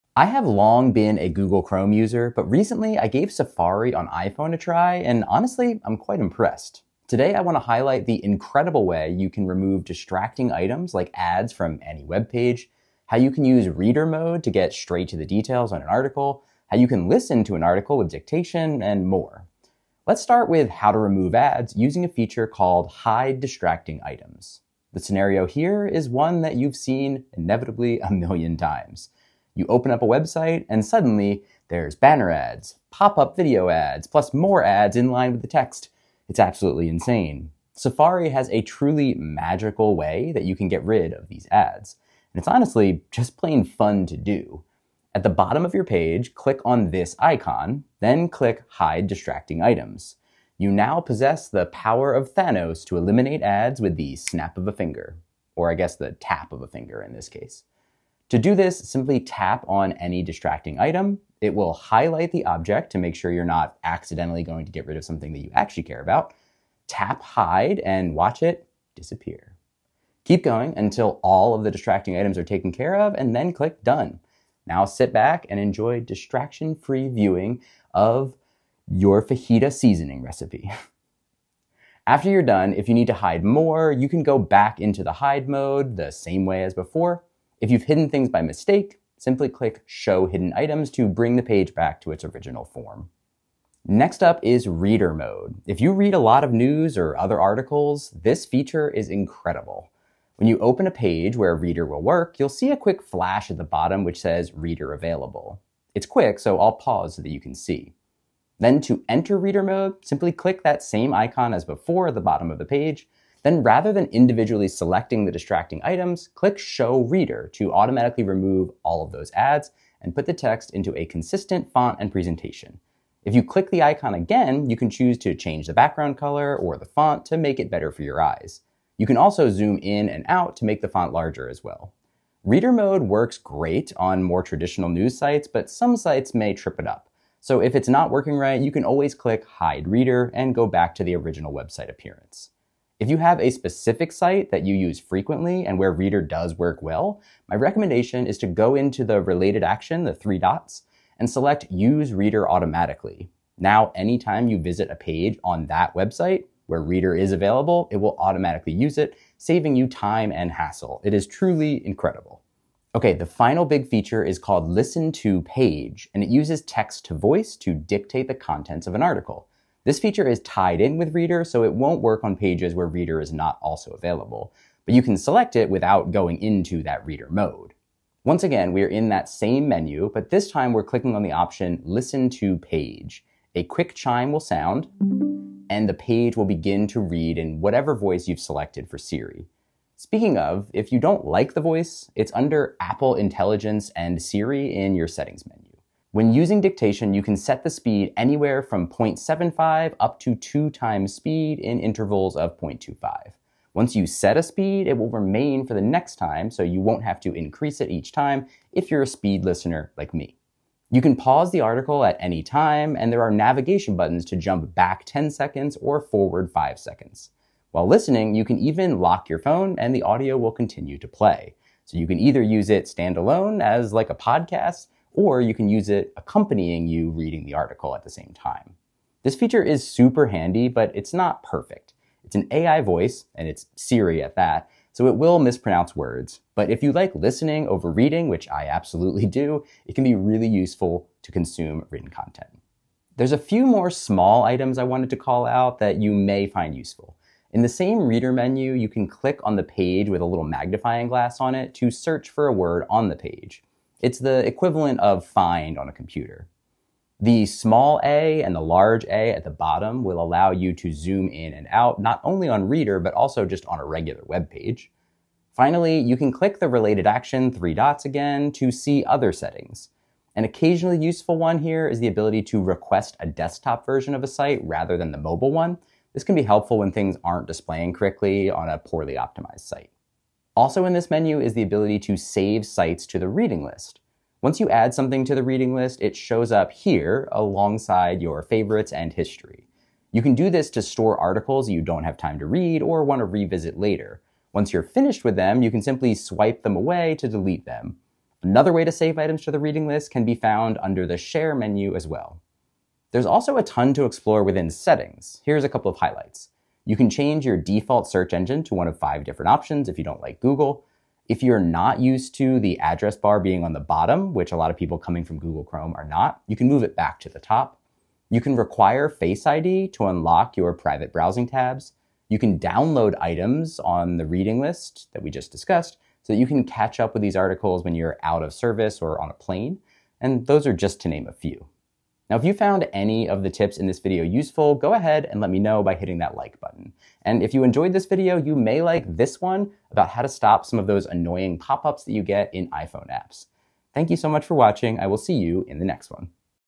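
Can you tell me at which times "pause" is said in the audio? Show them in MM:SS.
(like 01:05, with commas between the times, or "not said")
01:46, 03:31.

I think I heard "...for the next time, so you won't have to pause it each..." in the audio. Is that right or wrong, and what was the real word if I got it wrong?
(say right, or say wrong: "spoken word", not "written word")
wrong: "increase", not "pause".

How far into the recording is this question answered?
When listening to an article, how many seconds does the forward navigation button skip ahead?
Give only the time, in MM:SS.
03:36.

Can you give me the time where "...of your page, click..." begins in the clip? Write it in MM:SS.
00:45.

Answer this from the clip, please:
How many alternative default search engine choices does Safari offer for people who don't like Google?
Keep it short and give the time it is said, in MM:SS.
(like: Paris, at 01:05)
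5, at 05:08.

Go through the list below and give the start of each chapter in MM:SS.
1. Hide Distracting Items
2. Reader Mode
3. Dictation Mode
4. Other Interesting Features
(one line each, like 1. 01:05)
1. 00:20
2. 01:34
3. 02:43
4. 04:03.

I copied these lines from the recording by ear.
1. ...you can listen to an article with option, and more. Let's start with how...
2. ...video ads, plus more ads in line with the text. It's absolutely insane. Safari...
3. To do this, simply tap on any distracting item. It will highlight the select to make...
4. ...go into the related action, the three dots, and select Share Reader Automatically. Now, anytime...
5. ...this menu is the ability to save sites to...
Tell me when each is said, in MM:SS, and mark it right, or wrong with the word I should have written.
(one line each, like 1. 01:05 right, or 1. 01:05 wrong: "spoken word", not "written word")
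1. 00:16 wrong: "dictation", not "option"
2. 00:33 right
3. 00:58 wrong: "object", not "select"
4. 02:28 wrong: "Use", not "Share"
5. 04:40 right.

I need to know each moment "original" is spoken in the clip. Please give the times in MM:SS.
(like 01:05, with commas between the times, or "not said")
01:32, 02:21.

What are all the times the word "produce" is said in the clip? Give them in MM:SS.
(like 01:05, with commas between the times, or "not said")
not said.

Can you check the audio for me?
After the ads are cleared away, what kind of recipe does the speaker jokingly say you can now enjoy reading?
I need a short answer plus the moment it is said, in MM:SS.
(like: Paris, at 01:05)
Fajita seasoning, at 01:19.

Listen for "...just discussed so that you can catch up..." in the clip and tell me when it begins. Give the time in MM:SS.
05:25.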